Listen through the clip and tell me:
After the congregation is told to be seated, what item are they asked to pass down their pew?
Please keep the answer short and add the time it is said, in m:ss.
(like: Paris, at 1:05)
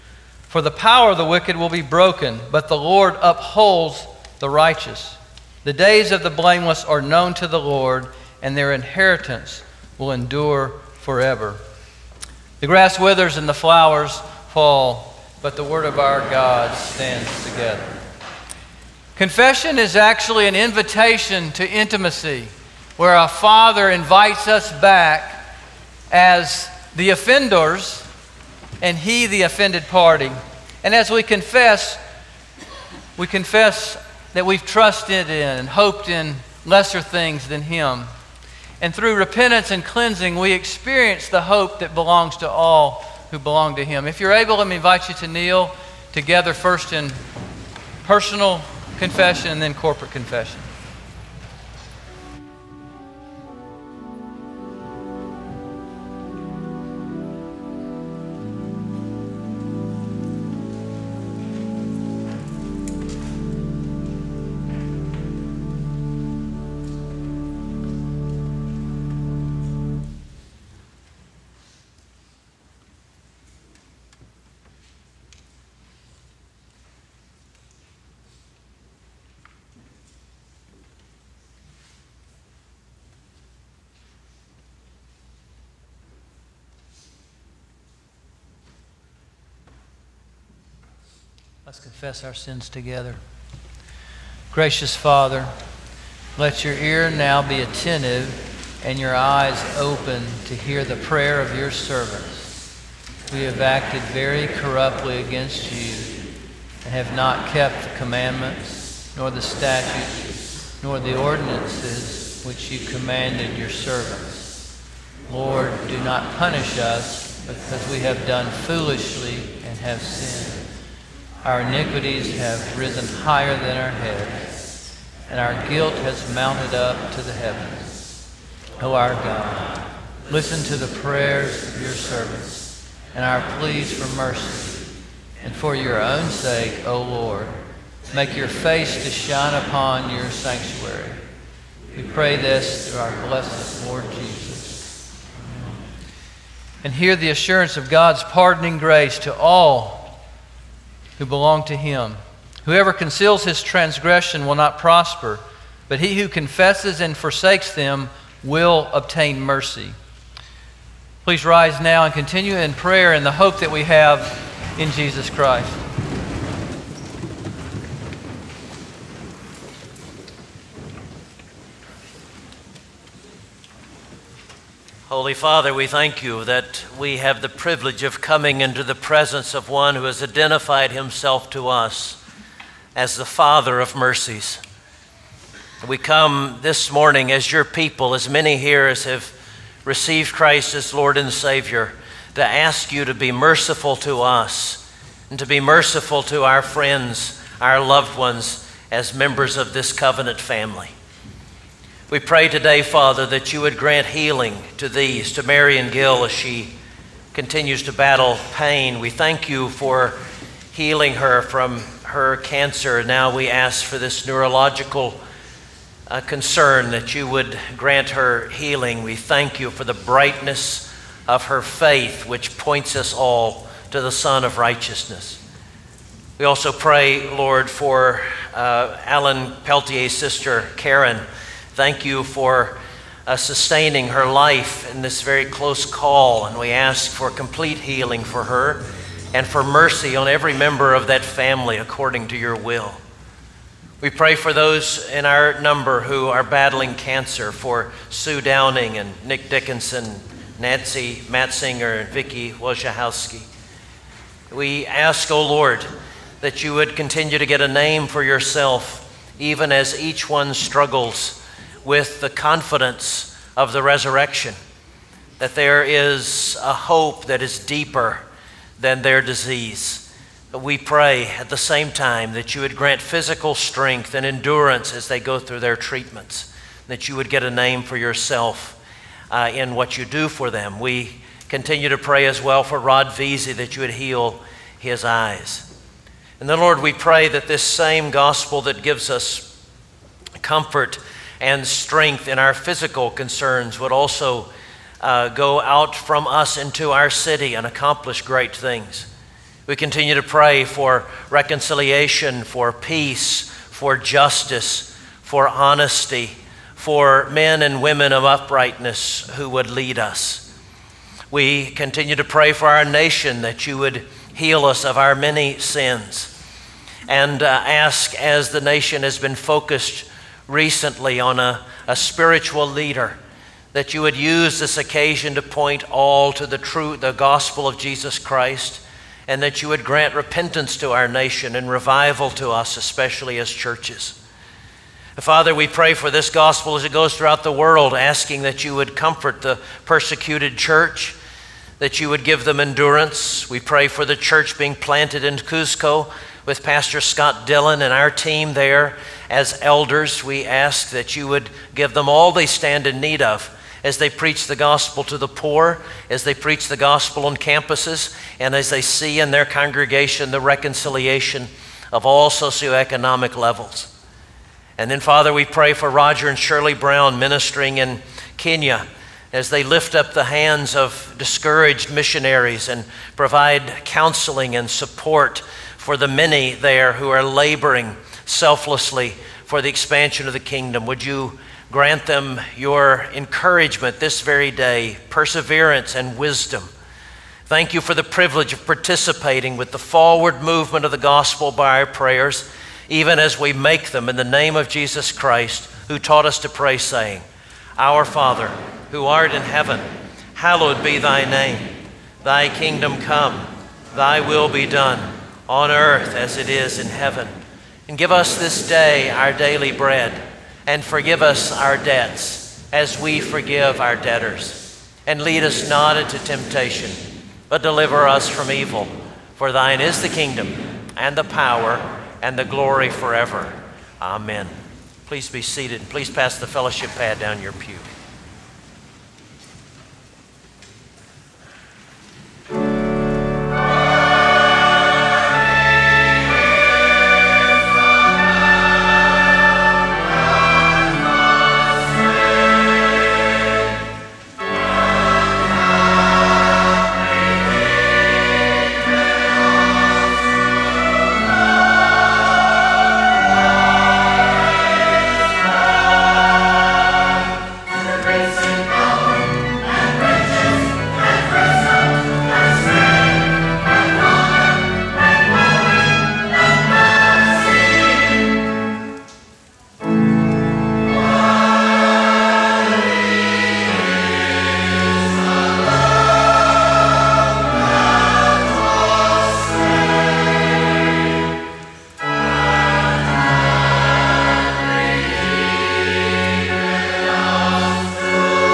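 Fellowship pad, at 7:06.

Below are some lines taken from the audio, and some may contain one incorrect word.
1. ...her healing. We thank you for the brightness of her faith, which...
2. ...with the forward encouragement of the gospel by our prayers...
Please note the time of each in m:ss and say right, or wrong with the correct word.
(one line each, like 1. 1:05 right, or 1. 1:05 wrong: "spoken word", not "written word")
1. 3:38 right
2. 6:29 wrong: "movement", not "encouragement".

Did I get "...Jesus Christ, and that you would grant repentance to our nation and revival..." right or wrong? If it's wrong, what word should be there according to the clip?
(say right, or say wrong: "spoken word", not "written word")
right.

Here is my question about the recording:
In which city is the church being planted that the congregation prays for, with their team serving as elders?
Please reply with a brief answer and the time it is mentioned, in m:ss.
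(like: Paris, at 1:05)
Cusco, at 5:45.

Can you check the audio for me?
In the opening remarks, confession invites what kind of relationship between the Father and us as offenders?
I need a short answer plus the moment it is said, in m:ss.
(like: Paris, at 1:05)
Intimacy, at 0:21.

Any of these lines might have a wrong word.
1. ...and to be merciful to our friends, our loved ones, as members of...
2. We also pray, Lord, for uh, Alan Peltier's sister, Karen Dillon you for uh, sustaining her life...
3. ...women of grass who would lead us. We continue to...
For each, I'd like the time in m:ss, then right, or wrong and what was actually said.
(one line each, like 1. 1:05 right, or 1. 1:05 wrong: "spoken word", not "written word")
1. 3:15 right
2. 3:46 wrong: "Thank", not "Dillon"
3. 5:07 wrong: "uprightness", not "grass".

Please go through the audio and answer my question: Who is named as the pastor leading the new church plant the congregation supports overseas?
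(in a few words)
Scott Dillon.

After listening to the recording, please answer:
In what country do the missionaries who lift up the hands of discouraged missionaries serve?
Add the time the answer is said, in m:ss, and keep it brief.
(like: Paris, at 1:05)
Kenya, at 6:08.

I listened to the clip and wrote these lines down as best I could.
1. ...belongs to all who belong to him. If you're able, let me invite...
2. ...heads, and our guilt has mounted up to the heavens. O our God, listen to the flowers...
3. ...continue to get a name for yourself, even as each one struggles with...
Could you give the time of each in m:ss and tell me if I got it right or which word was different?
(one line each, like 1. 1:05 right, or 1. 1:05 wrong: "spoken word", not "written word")
1. 0:41 right
2. 2:03 wrong: "prayers", not "flowers"
3. 4:16 right.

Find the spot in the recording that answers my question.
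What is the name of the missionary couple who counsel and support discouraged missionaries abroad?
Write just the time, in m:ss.
6:05.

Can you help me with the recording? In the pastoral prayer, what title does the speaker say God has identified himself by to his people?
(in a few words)
Father of mercies.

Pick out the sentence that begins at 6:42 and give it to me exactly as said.
Thy kingdom come, thy will be done, on earth as it is in heaven.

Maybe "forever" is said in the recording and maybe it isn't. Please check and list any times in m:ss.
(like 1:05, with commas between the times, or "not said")
0:11, 7:02.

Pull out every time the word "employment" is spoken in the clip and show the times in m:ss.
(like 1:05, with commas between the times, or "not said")
not said.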